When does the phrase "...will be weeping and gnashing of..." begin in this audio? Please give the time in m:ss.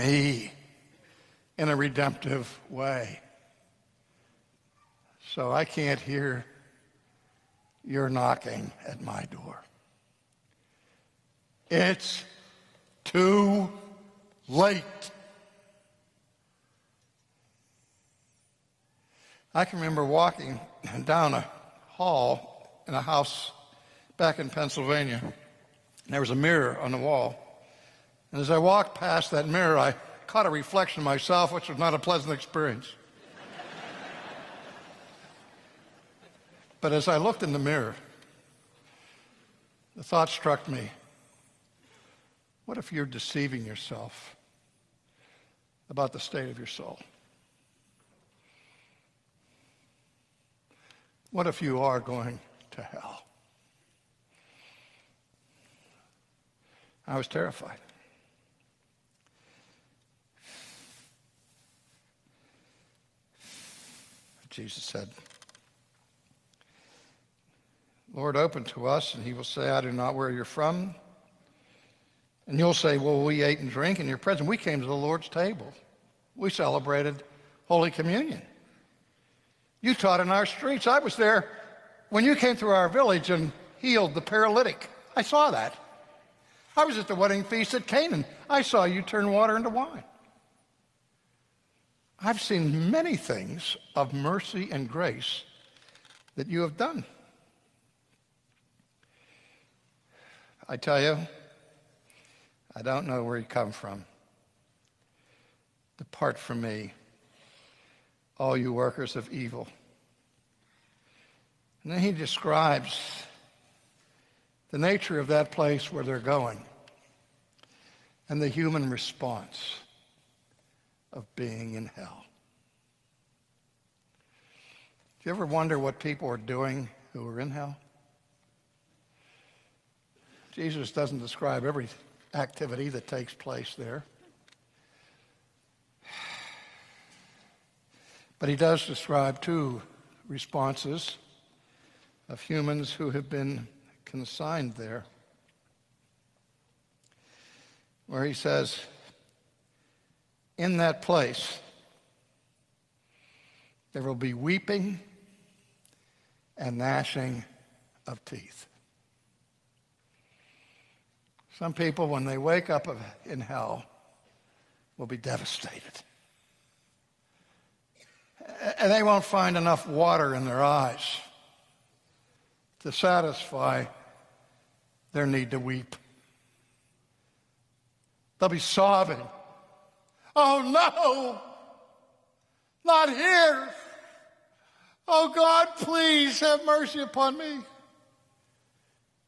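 2:34.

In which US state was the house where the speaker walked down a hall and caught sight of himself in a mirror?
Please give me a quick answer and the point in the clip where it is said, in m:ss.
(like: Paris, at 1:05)
Pennsylvania, at 0:24.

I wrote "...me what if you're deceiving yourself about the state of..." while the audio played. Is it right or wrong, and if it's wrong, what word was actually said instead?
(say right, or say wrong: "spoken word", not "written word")
right.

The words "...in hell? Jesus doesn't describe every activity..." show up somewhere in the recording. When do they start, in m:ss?
2:07.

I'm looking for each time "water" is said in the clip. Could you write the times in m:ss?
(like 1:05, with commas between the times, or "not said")
1:29, 2:49.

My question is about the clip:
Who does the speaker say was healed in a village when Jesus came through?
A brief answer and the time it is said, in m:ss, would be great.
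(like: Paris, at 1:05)
The paralytic, at 1:24.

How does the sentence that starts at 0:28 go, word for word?
And as I walked past that mirror, I caught a reflection of myself, which was not a pleasant experience.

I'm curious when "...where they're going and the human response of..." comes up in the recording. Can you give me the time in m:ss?
1:55.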